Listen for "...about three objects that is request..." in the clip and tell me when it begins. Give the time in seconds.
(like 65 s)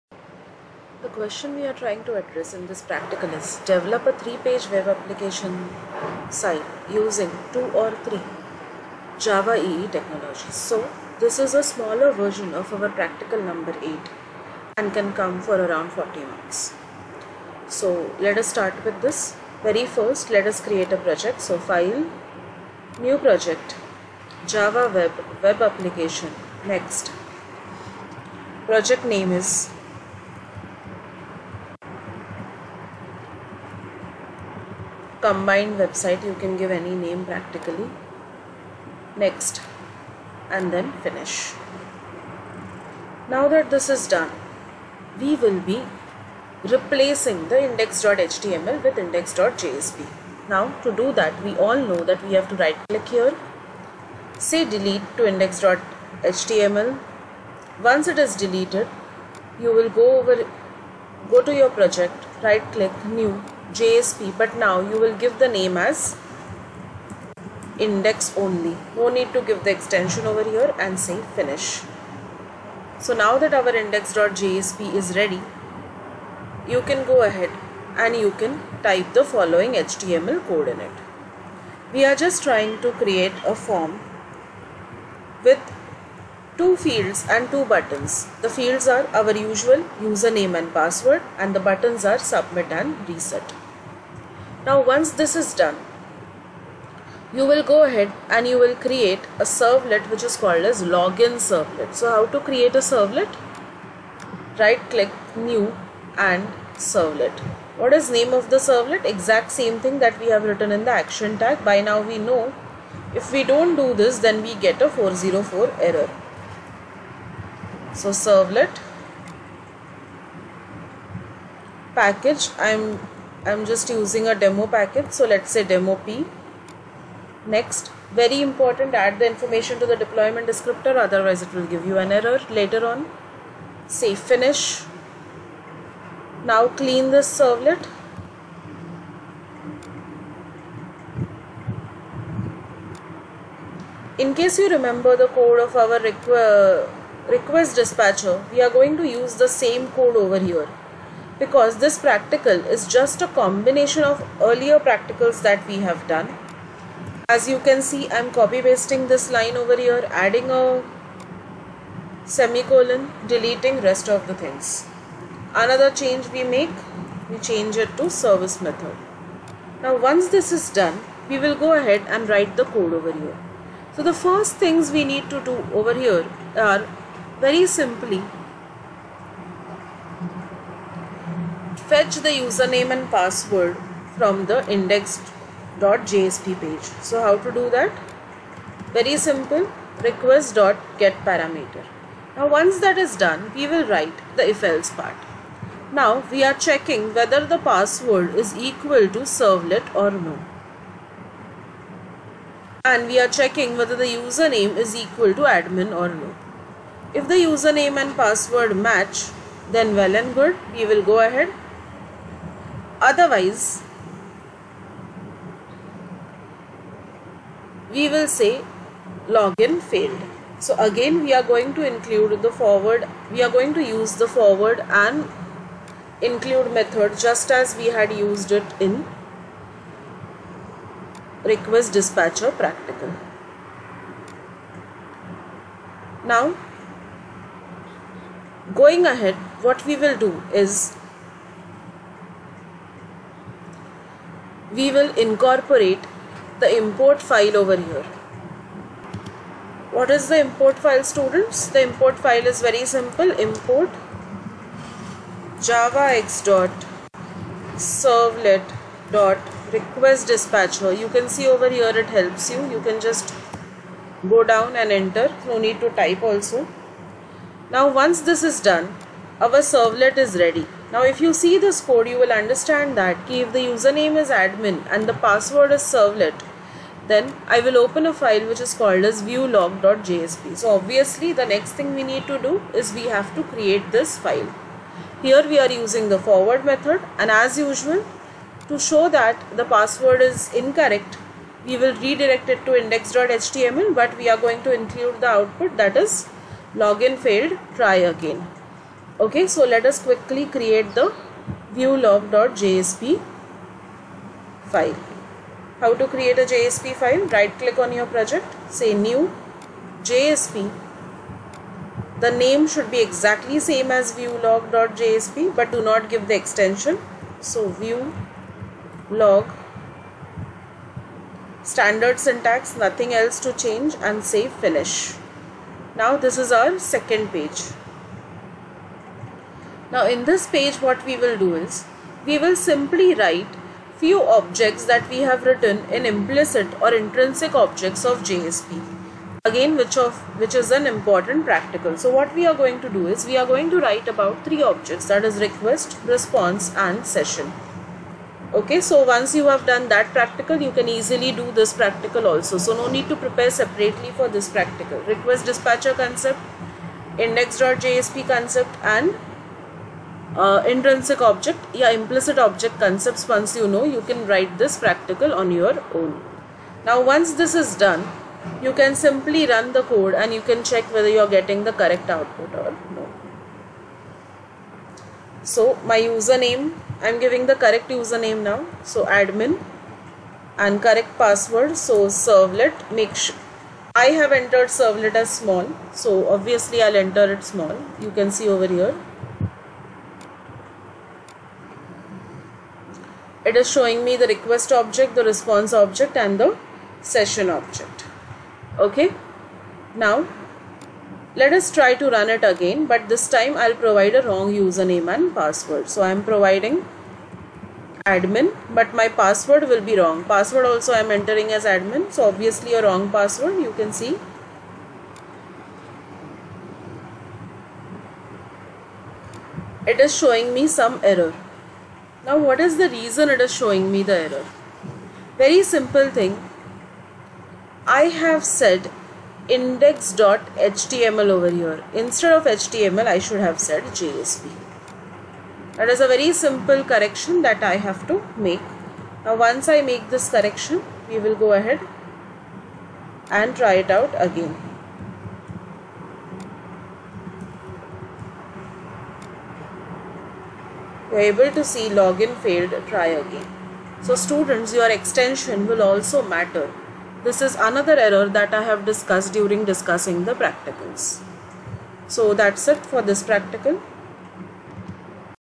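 344 s.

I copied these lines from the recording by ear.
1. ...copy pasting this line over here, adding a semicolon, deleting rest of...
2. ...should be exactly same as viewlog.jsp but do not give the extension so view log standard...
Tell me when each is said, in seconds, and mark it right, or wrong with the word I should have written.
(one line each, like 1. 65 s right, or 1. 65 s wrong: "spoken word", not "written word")
1. 158 s right
2. 312 s right.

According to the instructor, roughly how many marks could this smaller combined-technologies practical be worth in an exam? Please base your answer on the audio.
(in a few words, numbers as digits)
40.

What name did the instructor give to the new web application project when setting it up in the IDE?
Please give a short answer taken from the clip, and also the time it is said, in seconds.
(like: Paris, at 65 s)
combined website, at 35 s.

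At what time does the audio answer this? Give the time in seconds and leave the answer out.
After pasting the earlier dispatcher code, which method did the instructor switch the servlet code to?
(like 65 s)
168 s.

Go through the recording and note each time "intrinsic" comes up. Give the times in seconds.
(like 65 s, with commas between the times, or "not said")
336 s, 360 s.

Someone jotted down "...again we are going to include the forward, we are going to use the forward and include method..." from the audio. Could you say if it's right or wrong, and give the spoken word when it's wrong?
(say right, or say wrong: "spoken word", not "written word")
right.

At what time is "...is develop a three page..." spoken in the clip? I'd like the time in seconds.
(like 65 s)
3 s.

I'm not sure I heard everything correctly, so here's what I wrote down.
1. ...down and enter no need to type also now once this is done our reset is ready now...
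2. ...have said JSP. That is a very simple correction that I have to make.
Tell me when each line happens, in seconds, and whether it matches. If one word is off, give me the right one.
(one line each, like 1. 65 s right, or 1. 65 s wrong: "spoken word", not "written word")
1. 264 s wrong: "servlet", not "reset"
2. 433 s right.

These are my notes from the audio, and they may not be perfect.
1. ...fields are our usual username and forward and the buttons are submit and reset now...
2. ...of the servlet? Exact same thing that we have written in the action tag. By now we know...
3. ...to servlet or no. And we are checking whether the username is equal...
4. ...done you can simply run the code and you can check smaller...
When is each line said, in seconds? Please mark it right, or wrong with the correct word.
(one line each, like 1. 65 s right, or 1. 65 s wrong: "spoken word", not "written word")
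1. 88 s wrong: "password", not "forward"
2. 108 s right
3. 199 s right
4. 367 s wrong: "whether", not "smaller".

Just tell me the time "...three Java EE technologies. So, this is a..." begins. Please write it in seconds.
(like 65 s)
8 s.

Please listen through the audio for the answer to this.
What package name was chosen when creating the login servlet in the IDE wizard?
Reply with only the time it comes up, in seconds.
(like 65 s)
125 s.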